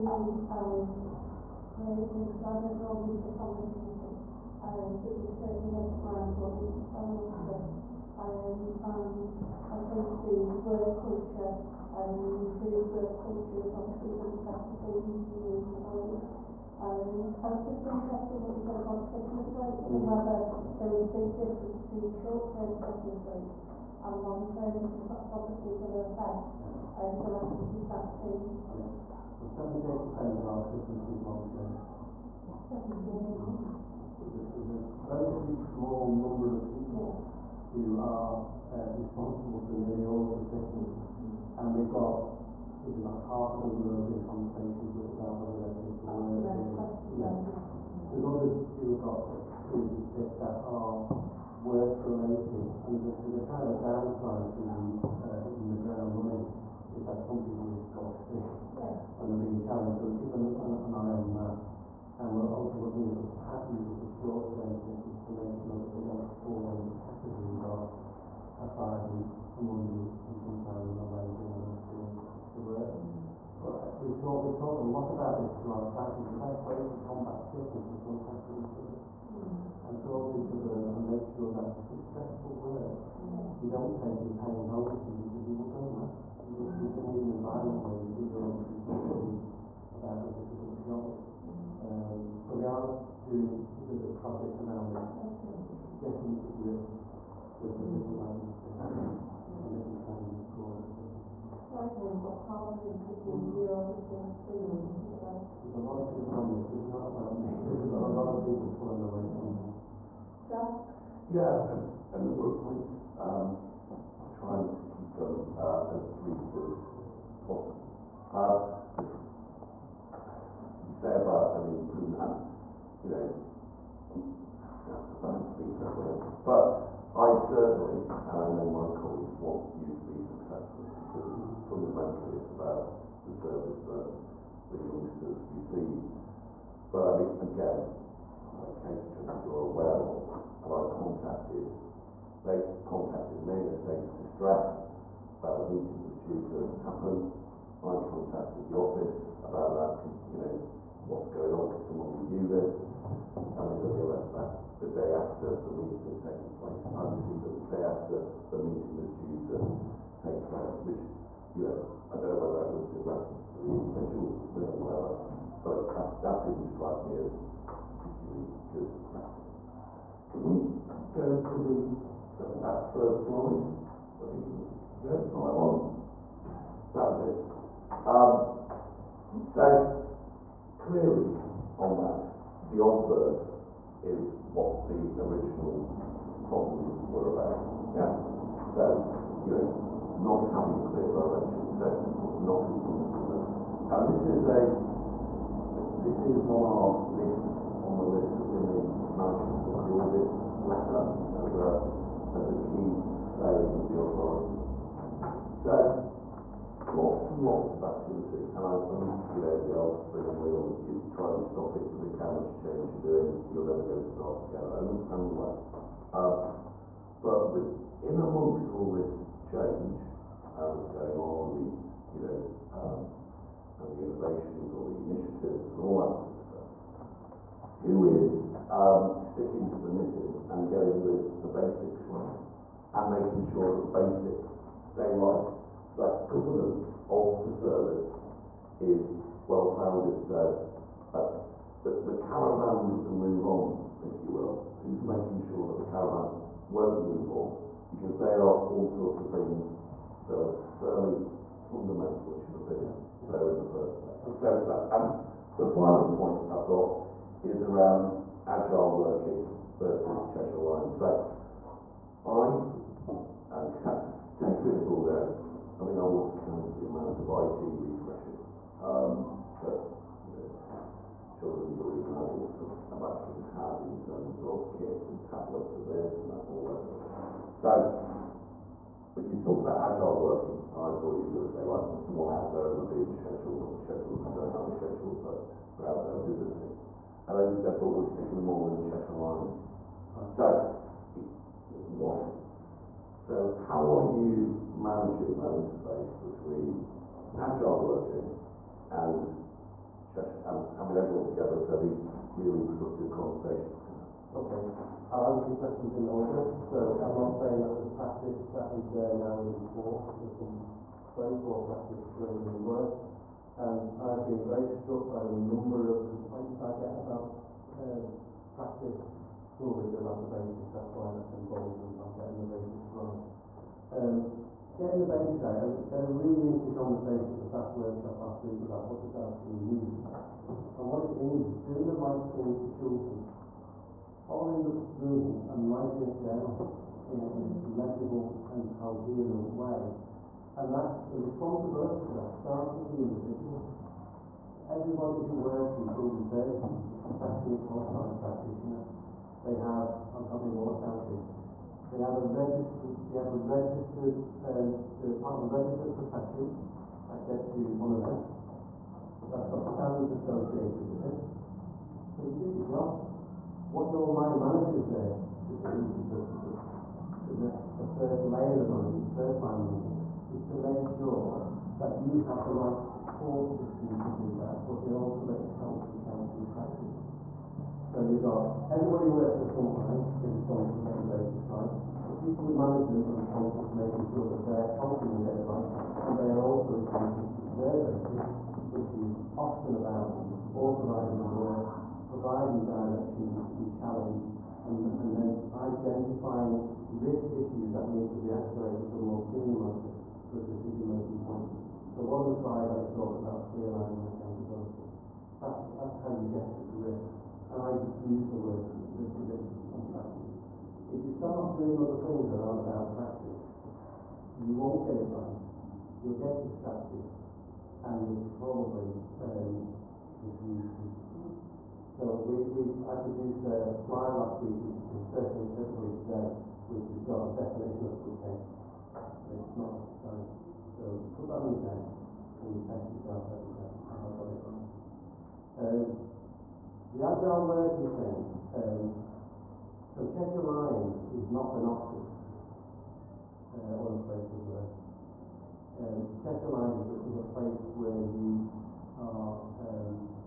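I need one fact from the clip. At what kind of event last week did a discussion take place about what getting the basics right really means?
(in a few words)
staff workshop.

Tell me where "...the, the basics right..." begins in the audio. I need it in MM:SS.
03:51.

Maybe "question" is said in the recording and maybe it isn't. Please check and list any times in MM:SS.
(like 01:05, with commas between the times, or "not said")
00:46, 05:05.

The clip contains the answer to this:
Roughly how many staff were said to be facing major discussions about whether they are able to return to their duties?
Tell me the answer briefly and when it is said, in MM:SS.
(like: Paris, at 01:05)
half a dozen, at 00:43.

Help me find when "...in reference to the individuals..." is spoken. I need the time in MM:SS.
02:42.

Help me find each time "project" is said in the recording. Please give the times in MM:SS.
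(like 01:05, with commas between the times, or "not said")
01:34.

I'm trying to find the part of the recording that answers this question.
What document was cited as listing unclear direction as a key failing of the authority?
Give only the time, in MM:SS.
03:20.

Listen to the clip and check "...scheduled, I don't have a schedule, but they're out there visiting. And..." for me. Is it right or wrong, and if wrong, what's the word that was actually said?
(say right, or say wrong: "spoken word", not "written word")
right.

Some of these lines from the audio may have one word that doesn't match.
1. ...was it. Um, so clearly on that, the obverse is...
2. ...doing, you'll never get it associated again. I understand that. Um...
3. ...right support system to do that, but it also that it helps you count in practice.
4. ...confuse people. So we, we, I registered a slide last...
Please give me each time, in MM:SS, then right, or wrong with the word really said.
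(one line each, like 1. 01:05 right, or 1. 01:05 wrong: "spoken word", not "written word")
1. 02:57 right
2. 03:33 wrong: "started", not "associated"
3. 06:12 right
4. 07:00 wrong: "produced", not "registered".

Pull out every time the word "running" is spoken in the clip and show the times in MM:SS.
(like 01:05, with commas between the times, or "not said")
00:06, 00:56.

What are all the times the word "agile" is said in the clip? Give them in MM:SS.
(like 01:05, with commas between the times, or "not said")
04:18, 04:39, 04:57, 07:17.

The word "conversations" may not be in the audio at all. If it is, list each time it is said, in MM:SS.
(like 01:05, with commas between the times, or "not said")
00:44, 05:03, 05:26.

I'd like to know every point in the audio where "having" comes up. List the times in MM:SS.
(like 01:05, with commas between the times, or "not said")
03:10, 05:00.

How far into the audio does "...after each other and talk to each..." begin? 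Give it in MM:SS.
01:18.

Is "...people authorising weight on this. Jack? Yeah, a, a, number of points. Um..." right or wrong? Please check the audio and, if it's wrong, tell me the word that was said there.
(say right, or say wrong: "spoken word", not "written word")
wrong: "pulling", not "authorising".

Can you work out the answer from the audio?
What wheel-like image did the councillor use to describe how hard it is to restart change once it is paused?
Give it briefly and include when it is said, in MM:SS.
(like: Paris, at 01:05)
spinning wheel, at 03:29.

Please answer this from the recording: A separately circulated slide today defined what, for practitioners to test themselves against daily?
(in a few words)
good case.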